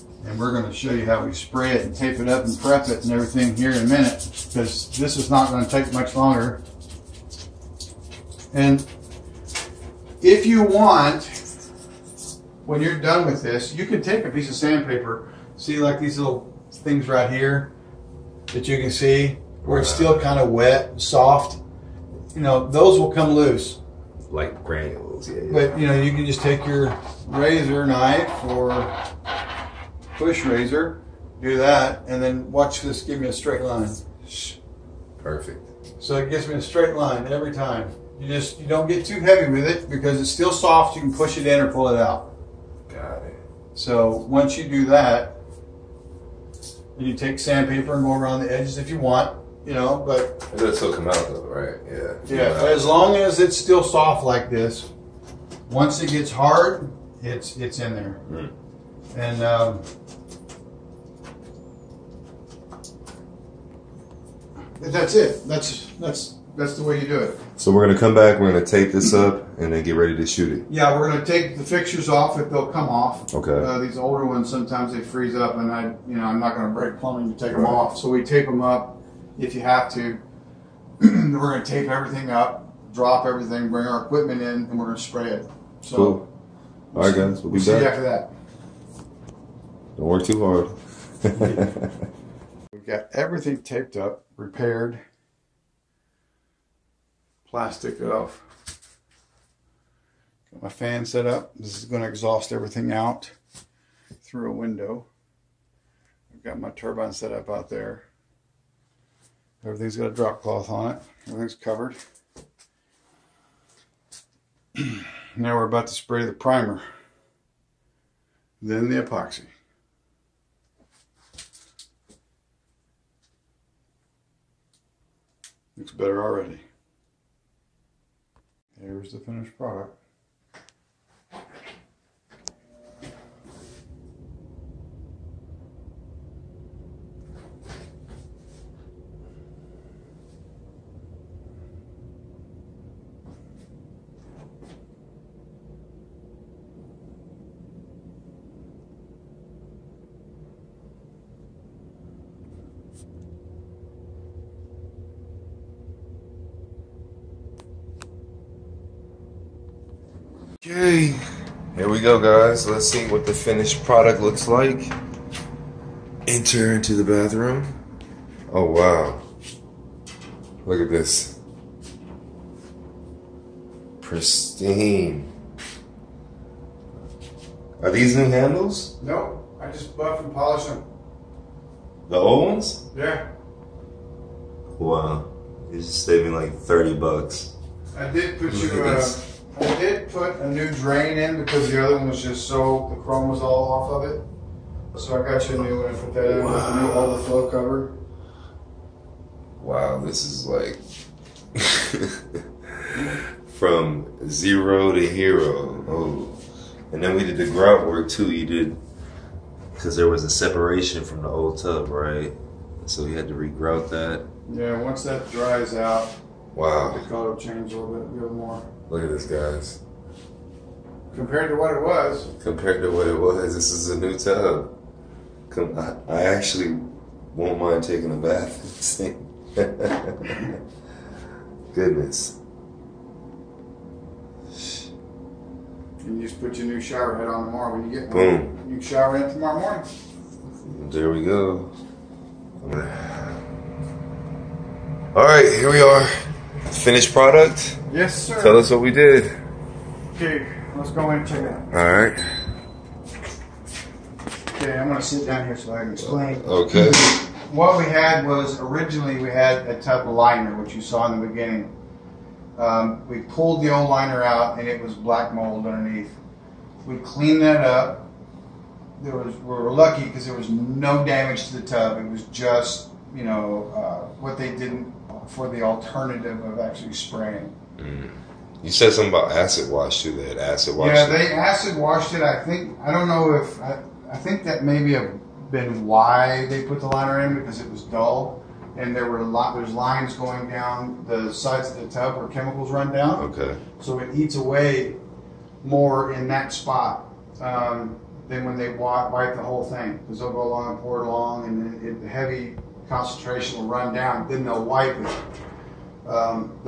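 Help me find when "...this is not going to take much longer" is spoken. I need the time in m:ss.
0:04.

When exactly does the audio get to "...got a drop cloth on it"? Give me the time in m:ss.
1:49.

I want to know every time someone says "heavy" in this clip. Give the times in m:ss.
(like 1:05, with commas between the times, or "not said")
0:39, 5:02.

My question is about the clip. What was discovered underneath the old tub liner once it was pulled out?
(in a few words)
black mold.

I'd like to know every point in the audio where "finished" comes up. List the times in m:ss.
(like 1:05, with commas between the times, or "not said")
2:09, 2:43, 4:06.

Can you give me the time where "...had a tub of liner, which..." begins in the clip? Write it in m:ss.
4:19.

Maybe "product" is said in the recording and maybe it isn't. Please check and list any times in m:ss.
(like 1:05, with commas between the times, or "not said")
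2:09, 2:43, 4:07.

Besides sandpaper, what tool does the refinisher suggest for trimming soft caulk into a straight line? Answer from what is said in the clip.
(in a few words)
razor knife.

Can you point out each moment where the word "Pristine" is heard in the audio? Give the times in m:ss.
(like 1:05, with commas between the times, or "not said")
2:53.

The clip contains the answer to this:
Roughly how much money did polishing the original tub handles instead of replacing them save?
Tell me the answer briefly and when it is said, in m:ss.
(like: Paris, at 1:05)
30 bucks, at 3:06.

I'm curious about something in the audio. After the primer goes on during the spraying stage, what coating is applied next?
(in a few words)
epoxy.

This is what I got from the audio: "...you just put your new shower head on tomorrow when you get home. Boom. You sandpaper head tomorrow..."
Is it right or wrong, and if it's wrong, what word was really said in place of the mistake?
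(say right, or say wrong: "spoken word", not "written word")
wrong: "shower", not "sandpaper".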